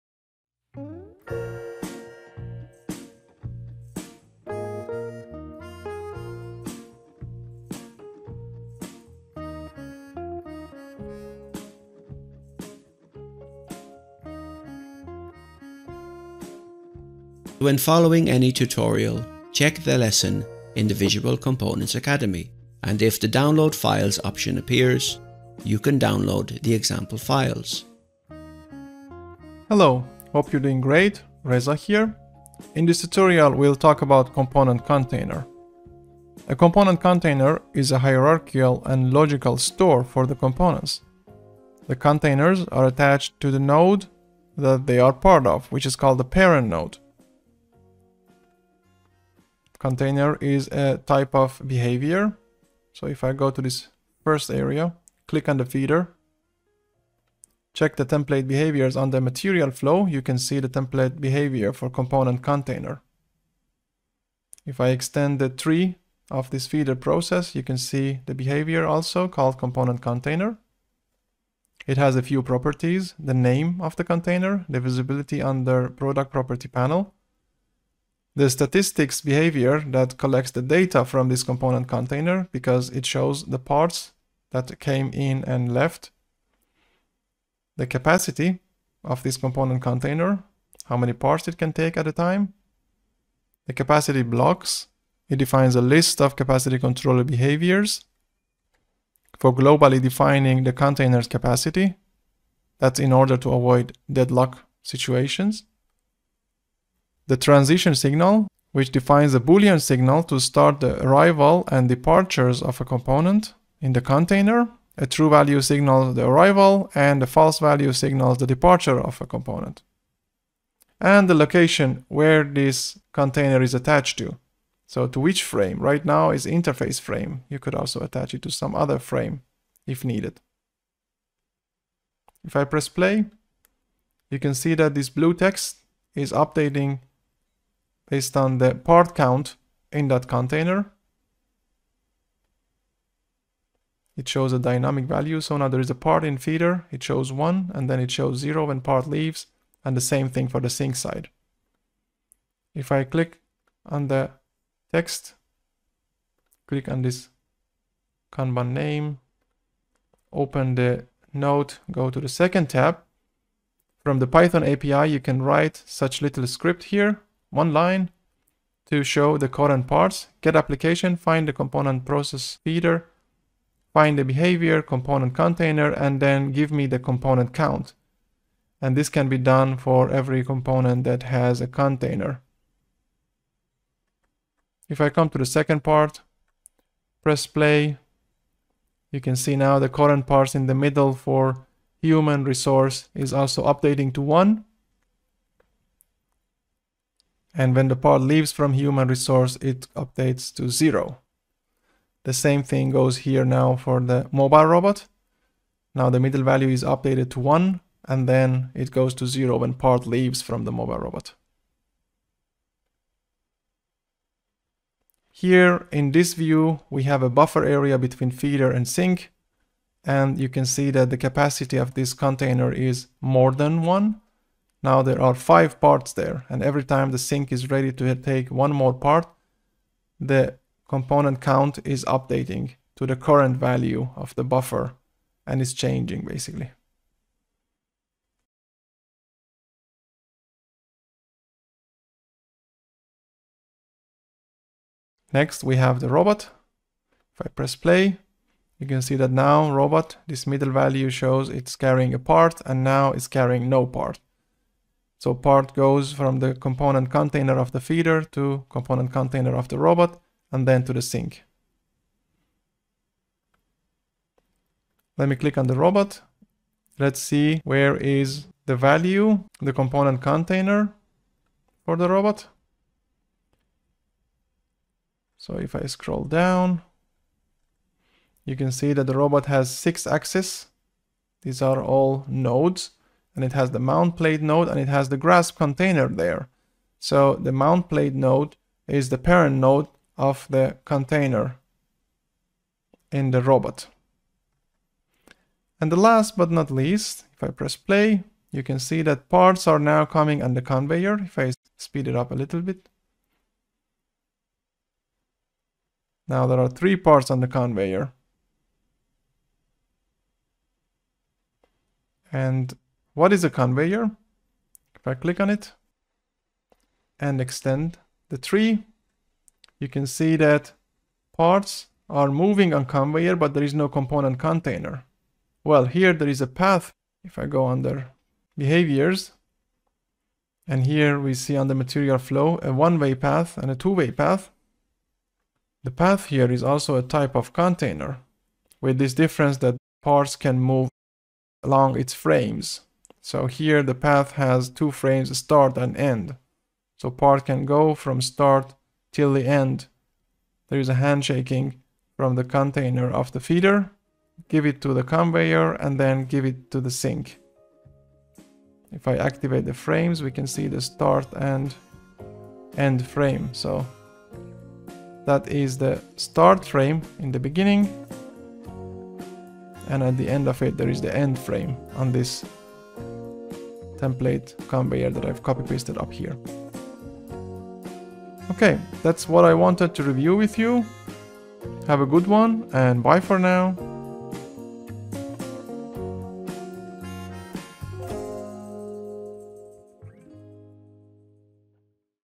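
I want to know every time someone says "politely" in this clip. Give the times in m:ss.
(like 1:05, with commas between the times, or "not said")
not said.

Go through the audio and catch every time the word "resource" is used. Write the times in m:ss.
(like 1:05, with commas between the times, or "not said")
3:12, 3:19.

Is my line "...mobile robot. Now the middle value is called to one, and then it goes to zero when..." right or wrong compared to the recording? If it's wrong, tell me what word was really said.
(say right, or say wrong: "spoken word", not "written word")
wrong: "updated", not "called".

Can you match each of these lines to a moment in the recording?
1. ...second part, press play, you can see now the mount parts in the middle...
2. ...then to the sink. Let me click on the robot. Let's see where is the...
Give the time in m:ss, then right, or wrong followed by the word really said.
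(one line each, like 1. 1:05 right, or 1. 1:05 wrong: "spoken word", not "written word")
1. 3:05 wrong: "current", not "mount"
2. 4:20 right.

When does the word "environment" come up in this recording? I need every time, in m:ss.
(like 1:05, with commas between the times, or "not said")
not said.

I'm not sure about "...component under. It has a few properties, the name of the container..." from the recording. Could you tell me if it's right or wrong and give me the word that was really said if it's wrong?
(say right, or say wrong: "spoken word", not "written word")
wrong: "container", not "under".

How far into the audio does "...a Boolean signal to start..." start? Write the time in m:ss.
1:49.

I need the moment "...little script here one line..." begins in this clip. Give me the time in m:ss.
2:46.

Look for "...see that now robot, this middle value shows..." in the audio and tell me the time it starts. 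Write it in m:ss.
4:09.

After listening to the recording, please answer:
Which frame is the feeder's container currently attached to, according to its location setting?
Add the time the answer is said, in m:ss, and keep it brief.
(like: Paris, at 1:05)
interface frame, at 2:06.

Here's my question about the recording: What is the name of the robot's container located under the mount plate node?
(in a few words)
grasp container.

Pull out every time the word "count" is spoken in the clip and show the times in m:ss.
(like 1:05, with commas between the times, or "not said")
2:19, 2:57, 3:51.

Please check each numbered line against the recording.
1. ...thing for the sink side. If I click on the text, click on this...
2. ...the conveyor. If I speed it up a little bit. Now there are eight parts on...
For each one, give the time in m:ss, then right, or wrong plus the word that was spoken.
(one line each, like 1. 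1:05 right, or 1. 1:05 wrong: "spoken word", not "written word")
1. 2:30 right
2. 5:00 wrong: "three", not "eight".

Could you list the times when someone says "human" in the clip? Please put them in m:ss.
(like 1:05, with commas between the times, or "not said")
3:12, 3:18.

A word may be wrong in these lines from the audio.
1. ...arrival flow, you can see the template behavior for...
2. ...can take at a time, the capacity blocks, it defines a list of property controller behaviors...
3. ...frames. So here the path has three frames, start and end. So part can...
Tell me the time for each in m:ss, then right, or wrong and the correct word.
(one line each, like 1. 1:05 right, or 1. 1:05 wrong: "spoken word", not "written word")
1. 0:59 wrong: "material", not "arrival"
2. 1:31 wrong: "capacity", not "property"
3. 5:42 wrong: "two", not "three".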